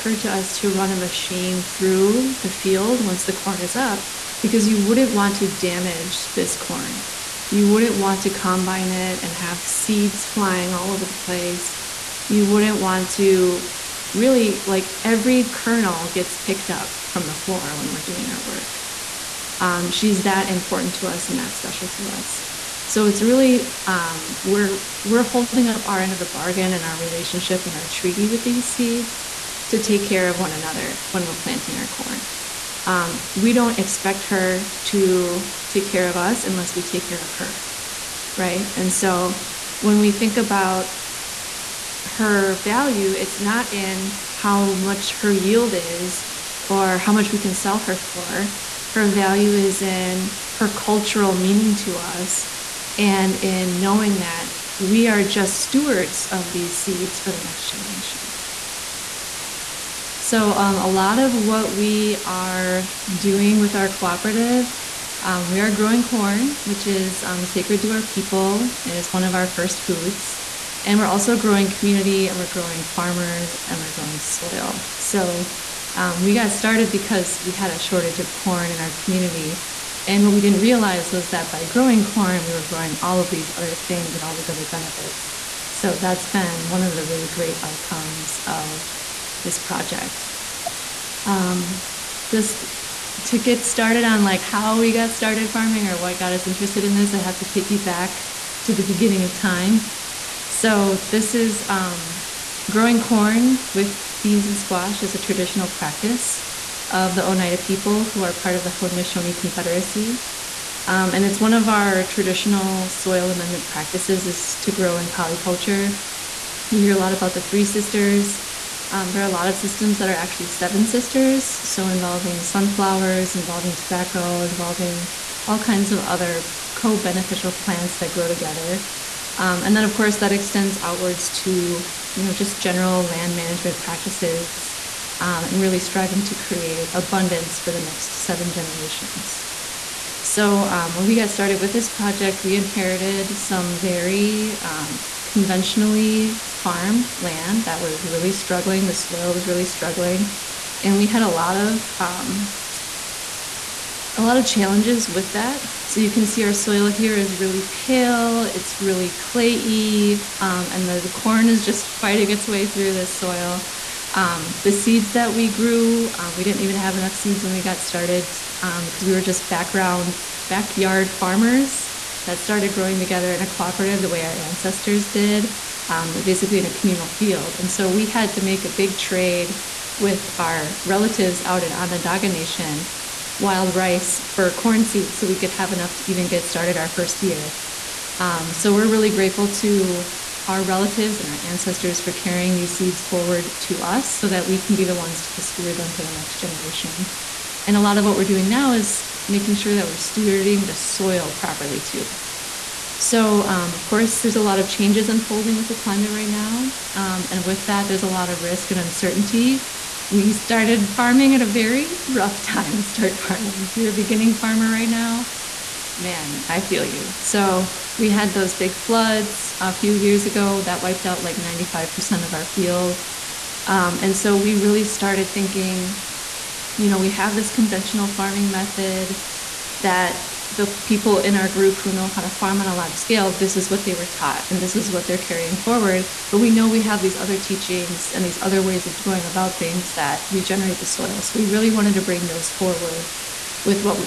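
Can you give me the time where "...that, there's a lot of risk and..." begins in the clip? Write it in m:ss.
3:27.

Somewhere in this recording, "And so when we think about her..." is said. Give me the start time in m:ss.
0:38.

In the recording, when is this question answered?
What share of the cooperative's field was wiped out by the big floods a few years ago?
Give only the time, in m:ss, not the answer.
3:41.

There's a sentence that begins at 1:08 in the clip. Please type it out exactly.
It is one of our first foods.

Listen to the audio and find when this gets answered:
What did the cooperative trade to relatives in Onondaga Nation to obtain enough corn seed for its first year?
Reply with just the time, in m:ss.
3:03.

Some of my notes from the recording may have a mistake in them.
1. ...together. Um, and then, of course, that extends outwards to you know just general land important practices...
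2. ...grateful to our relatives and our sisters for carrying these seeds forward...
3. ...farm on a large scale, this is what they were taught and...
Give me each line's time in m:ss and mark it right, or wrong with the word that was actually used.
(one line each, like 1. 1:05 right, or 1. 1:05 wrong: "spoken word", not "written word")
1. 2:08 wrong: "management", not "important"
2. 3:09 wrong: "ancestors", not "sisters"
3. 3:52 right.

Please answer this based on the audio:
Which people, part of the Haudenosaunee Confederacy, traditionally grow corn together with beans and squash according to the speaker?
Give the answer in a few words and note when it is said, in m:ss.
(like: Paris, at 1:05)
Oneida, at 1:47.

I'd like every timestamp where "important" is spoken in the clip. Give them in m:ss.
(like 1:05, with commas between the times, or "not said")
0:20.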